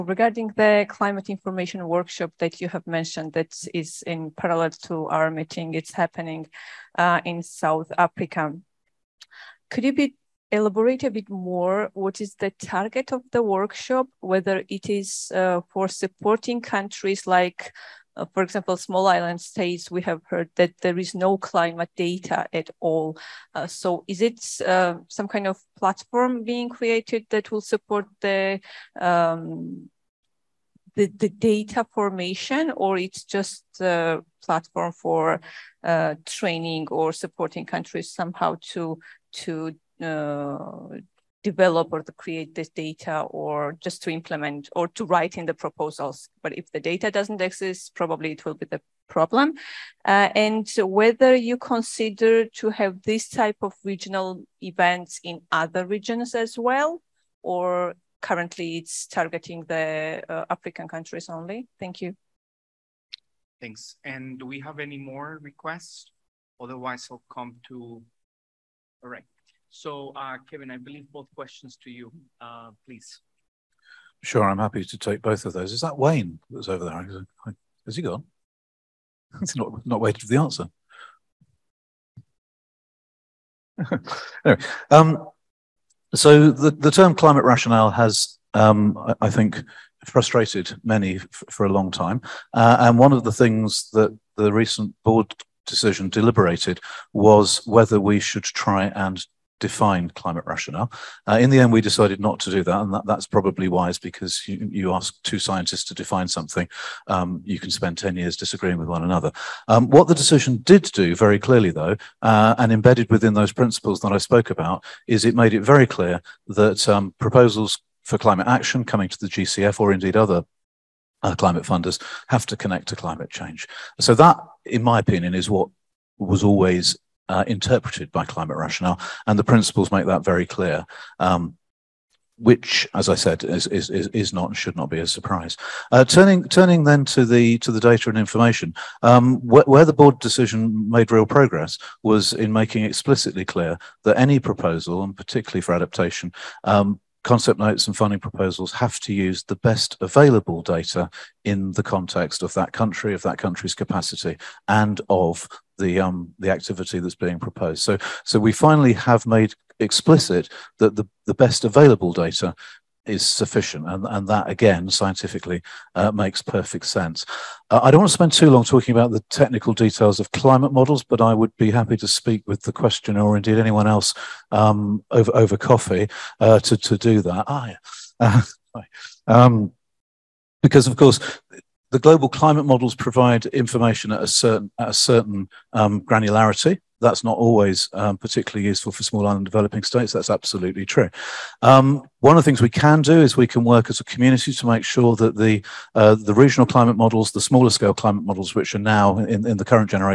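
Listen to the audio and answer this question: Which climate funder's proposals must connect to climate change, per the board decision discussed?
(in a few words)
GCF.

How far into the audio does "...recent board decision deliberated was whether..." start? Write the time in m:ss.
1:34.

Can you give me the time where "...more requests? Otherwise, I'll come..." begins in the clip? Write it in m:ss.
1:04.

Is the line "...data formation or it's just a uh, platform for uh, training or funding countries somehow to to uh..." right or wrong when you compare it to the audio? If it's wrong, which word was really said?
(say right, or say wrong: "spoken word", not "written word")
wrong: "supporting", not "funding".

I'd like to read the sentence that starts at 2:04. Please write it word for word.
So that, in my opinion, is what was always uh, interpreted by climate rationale, and the principles make that very clear.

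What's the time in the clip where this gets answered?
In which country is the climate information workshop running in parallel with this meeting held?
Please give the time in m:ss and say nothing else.
0:07.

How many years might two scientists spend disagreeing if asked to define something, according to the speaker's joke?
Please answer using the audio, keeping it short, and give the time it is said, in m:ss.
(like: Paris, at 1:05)
10, at 1:47.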